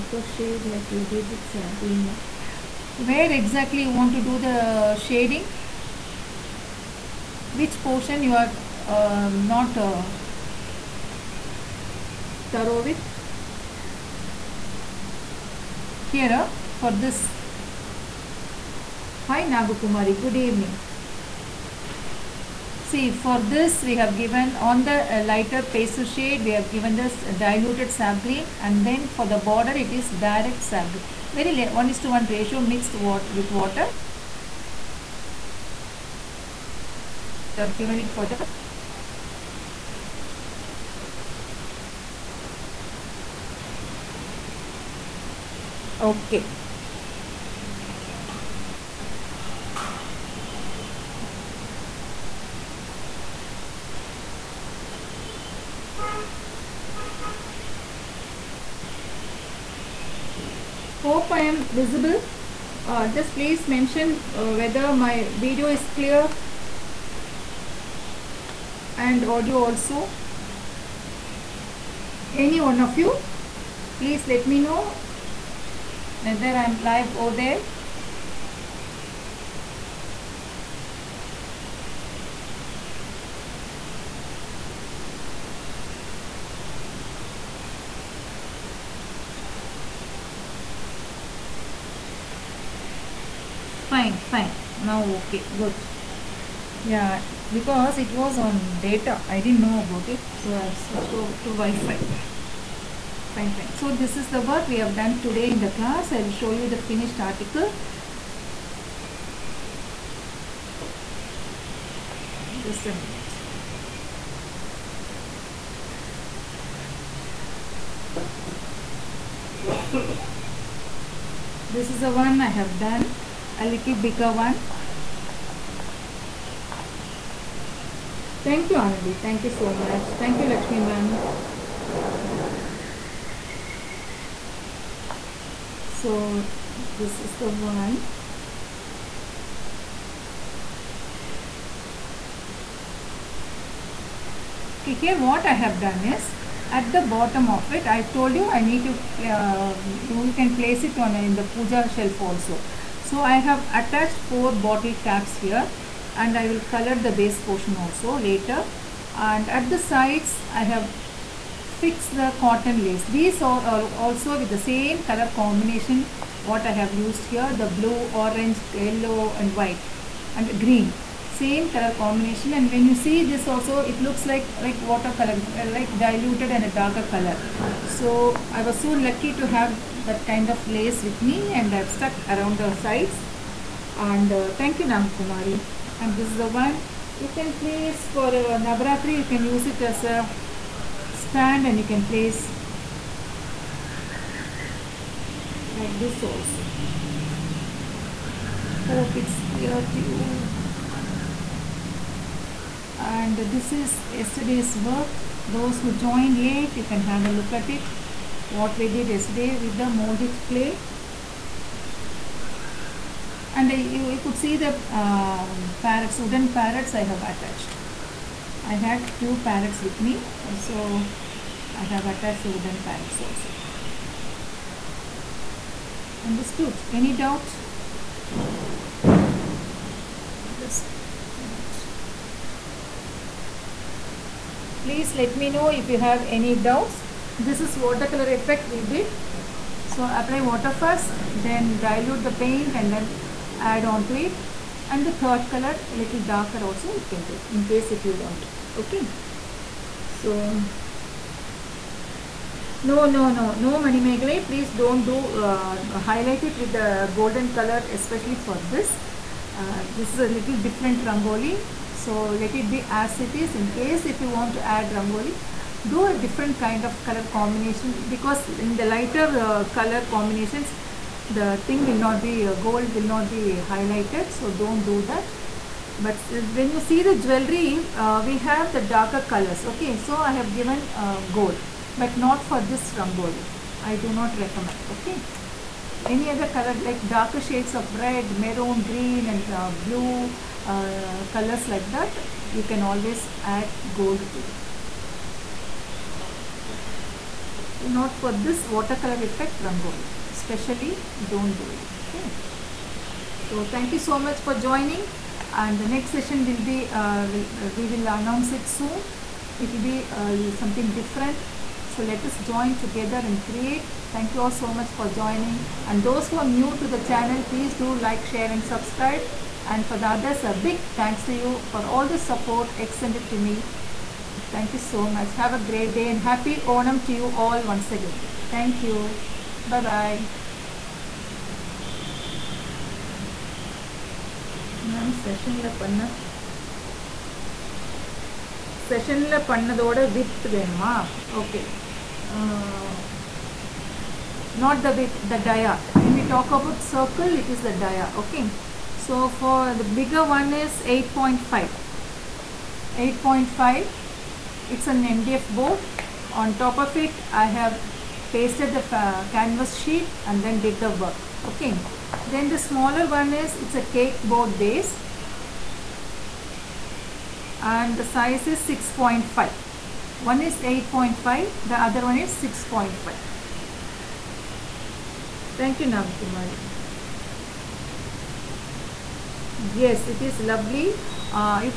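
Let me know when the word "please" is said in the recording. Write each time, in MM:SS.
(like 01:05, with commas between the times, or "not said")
01:03, 01:14, 03:54, 04:14, 05:17.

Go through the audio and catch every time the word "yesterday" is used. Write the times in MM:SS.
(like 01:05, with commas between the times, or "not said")
03:24, 03:29.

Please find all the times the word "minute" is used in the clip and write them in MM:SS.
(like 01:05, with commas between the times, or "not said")
01:53, 03:51.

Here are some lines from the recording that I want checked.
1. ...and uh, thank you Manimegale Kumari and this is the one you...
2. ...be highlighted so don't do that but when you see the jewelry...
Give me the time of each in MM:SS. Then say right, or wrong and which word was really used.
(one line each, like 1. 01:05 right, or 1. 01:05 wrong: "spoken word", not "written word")
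1. 03:03 wrong: "Nang", not "Manimegale"
2. 04:33 right.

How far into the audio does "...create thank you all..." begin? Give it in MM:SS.
05:13.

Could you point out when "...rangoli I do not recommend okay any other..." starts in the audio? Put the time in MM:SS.
04:42.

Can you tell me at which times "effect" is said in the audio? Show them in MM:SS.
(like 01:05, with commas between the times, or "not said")
03:58, 04:59.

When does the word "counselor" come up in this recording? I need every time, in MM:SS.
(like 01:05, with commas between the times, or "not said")
not said.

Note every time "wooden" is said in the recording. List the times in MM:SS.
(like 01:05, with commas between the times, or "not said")
03:36, 03:42.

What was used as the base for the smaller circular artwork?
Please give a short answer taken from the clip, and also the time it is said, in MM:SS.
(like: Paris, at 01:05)
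cake board, at 06:03.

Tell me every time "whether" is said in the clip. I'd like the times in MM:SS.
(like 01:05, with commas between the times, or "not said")
01:04, 01:16.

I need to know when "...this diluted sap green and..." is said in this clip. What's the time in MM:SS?
00:26.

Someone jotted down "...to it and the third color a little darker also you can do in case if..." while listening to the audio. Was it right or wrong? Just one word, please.
right.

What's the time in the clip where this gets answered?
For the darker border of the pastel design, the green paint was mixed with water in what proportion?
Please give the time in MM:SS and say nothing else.
00:31.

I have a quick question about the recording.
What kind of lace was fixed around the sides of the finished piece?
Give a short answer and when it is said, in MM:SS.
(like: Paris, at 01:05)
cotton lace, at 02:42.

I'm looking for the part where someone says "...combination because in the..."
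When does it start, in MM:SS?
04:27.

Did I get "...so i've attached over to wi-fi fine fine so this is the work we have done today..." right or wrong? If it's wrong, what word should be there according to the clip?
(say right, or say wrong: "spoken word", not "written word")
wrong: "switched", not "attached".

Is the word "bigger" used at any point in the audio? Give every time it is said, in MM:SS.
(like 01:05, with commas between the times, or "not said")
02:03, 05:49.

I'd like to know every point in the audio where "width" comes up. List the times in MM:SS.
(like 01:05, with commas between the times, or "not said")
05:39, 05:44.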